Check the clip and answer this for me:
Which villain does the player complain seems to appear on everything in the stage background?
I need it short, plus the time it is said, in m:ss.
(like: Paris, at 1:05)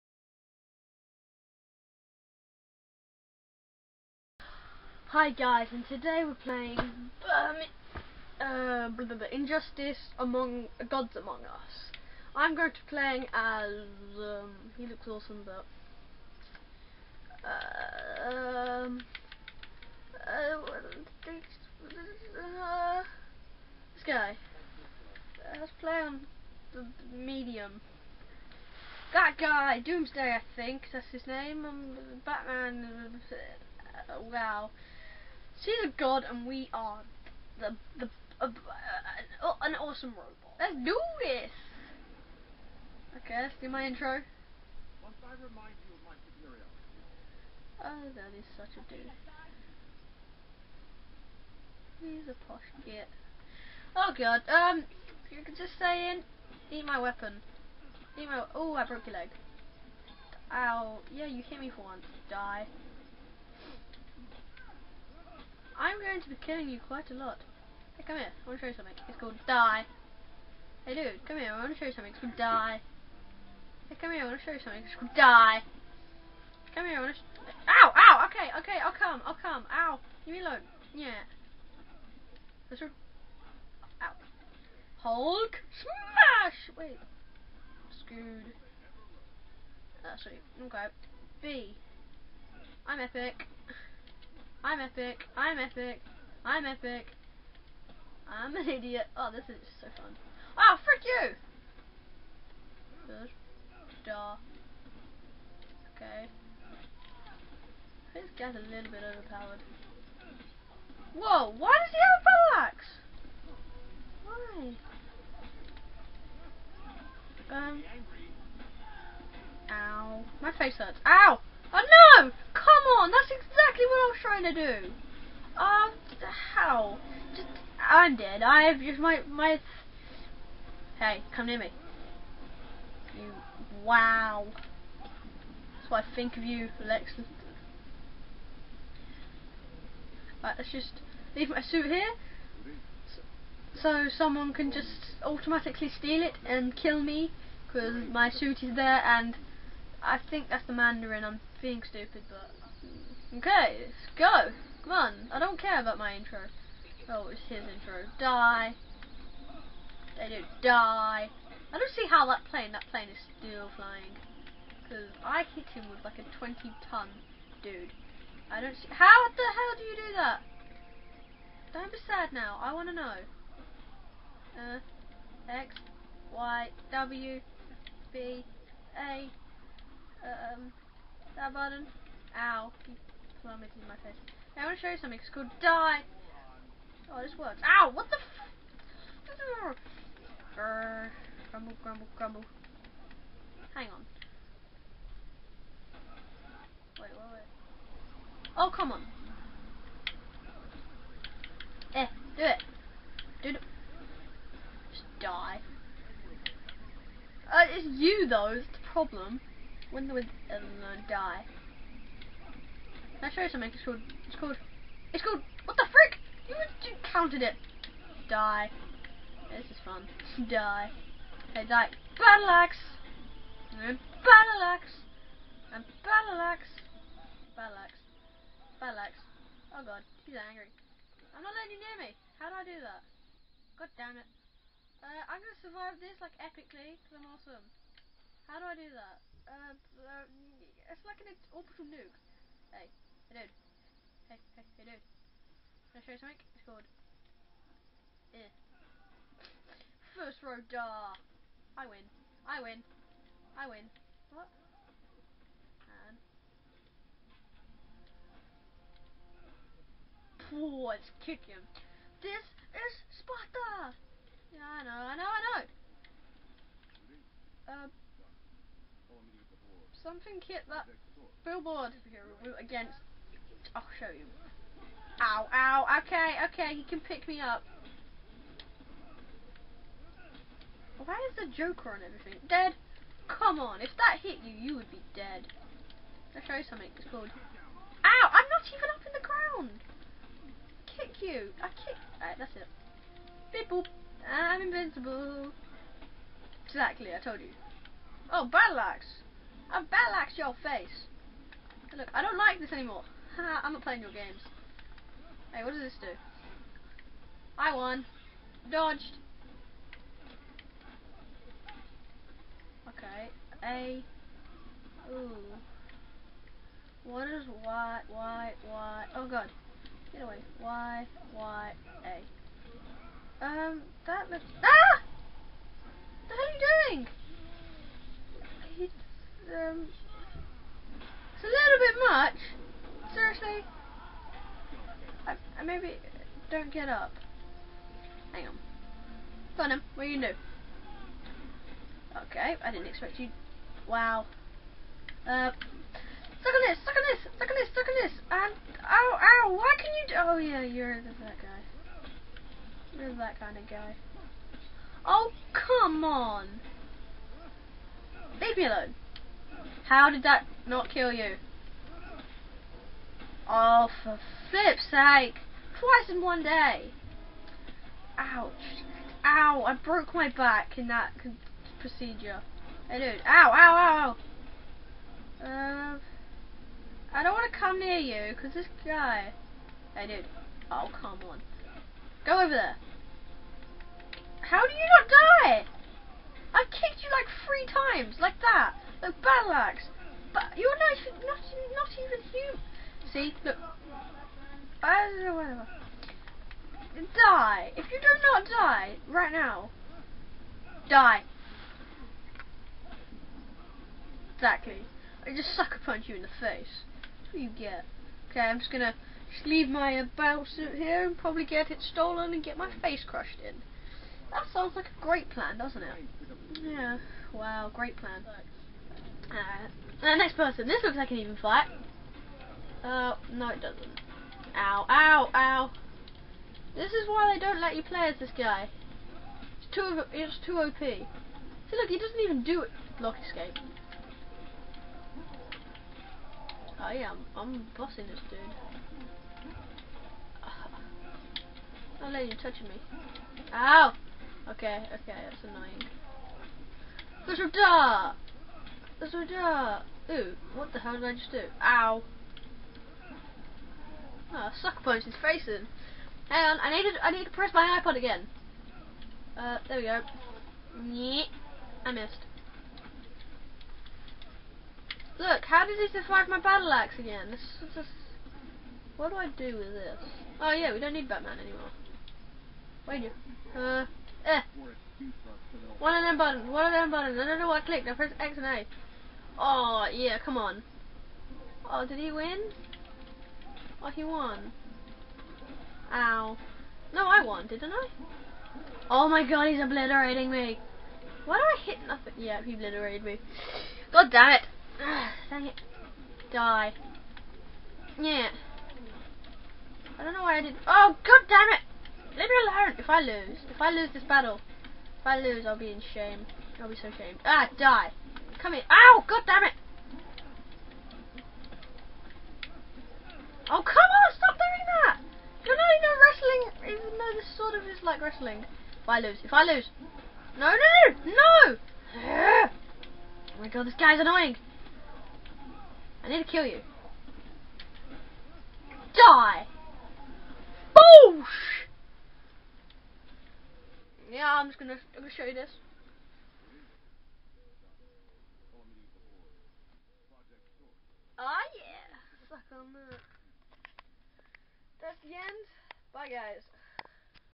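The Joker, at 4:41.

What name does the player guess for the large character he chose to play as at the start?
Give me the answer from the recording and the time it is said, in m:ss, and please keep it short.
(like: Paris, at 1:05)
Doomsday, at 0:29.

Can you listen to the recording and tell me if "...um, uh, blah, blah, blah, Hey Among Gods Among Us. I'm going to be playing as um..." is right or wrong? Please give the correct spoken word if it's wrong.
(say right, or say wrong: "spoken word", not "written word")
wrong: "Injustice", not "Hey".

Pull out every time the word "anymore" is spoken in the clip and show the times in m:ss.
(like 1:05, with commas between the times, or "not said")
5:02, 7:51.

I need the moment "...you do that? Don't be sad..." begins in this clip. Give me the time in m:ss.
2:49.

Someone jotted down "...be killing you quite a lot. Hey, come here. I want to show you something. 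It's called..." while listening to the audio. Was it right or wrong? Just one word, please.
right.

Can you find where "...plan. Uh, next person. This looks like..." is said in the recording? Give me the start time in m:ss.
6:57.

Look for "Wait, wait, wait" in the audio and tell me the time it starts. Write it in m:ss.
3:16.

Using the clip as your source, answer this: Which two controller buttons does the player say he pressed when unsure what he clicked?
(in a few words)
X and A.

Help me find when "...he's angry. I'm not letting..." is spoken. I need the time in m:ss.
3:50.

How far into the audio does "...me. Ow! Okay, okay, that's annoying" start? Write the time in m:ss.
7:22.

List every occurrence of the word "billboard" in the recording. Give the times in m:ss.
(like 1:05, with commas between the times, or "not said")
4:31.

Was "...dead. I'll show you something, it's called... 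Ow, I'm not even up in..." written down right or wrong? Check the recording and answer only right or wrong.
right.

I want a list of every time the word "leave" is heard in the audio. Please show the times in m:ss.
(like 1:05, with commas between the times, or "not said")
1:20, 2:21, 5:58, 6:49, 8:22.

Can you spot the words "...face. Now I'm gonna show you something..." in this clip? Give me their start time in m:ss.
3:04.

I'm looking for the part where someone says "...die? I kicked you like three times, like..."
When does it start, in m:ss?
6:25.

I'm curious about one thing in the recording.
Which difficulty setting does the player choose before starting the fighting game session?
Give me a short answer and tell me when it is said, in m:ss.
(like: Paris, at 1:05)
Medium, at 0:27.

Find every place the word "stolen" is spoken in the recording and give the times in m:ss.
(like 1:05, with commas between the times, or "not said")
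6:51.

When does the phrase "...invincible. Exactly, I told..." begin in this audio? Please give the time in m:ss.
4:54.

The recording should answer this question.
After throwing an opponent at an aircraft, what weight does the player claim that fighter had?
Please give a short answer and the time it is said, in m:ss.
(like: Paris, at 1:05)
20 tons, at 2:46.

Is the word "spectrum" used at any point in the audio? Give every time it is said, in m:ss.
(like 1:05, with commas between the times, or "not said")
not said.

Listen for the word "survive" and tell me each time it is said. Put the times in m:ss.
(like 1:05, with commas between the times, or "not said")
3:55, 7:45.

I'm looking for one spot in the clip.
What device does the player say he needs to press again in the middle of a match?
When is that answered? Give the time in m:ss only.
7:37.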